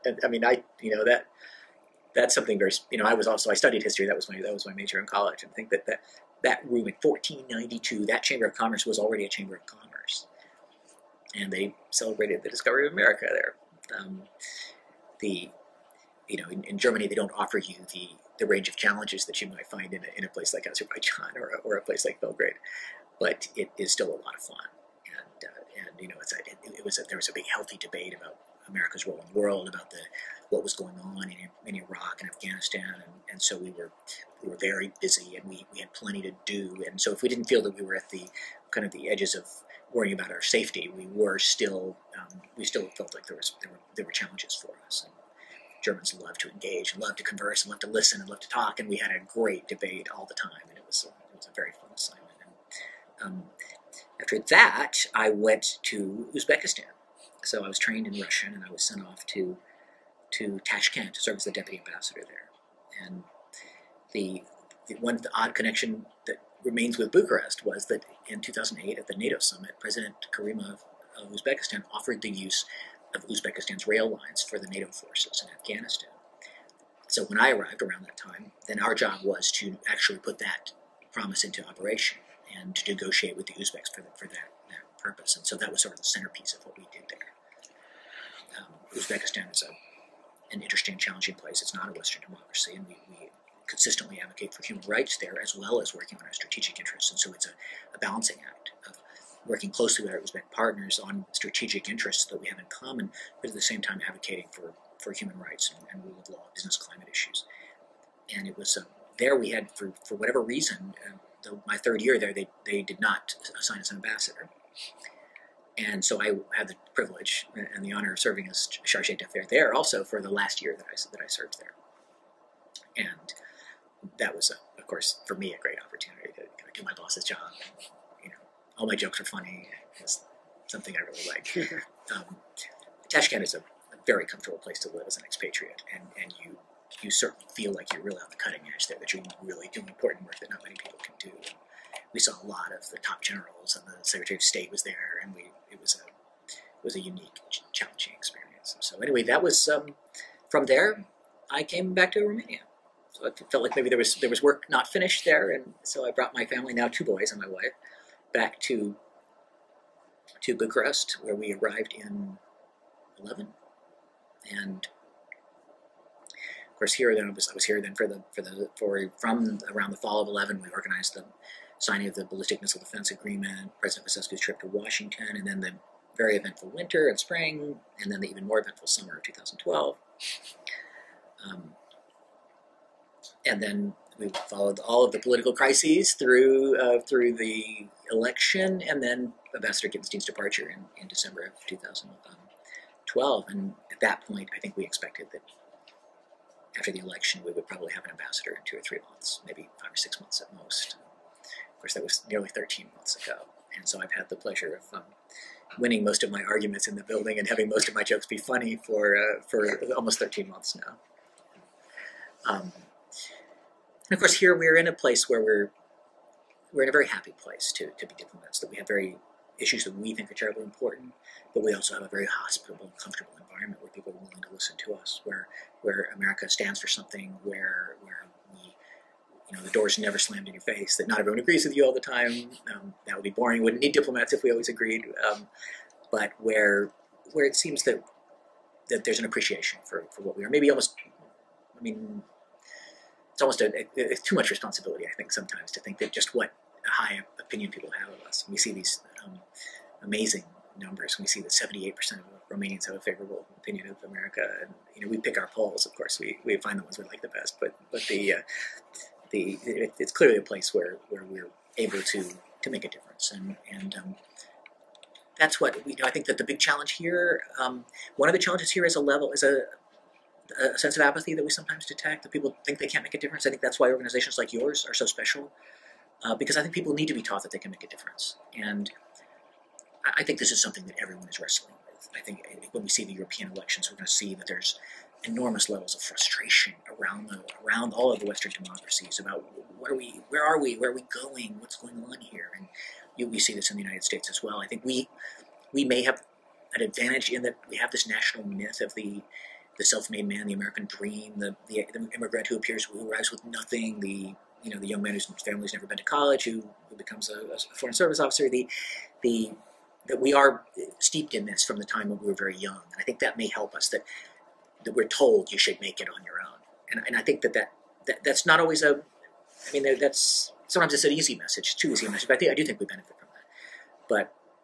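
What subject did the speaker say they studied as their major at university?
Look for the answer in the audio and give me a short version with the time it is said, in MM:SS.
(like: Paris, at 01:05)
History, at 00:03.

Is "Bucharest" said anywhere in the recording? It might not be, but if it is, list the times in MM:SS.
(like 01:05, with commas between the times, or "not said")
01:07, 02:40.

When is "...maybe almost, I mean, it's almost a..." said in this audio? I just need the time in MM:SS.
04:00.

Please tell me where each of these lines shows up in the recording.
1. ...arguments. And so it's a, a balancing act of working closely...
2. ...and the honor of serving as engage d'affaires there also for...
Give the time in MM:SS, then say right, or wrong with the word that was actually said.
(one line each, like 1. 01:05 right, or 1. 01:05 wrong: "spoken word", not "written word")
1. 01:36 wrong: "interests", not "arguments"
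2. 01:57 wrong: "charge", not "engage".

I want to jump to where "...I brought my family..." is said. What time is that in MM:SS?
02:36.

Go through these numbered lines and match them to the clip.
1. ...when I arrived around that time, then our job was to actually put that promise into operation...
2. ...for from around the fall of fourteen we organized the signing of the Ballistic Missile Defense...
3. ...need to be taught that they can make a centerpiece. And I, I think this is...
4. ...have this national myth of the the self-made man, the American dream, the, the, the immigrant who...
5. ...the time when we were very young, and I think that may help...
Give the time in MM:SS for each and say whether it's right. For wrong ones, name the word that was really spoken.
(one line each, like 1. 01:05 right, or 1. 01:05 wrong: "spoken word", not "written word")
1. 01:17 right
2. 02:48 wrong: "eleven", not "fourteen"
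3. 04:36 wrong: "difference", not "centerpiece"
4. 04:57 right
5. 05:11 right.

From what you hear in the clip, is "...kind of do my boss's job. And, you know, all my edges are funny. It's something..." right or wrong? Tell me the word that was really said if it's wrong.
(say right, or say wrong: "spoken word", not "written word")
wrong: "jokes", not "edges".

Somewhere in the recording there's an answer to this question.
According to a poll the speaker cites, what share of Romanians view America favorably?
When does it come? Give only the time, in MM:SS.
04:11.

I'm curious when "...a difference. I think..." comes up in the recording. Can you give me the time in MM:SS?
04:33.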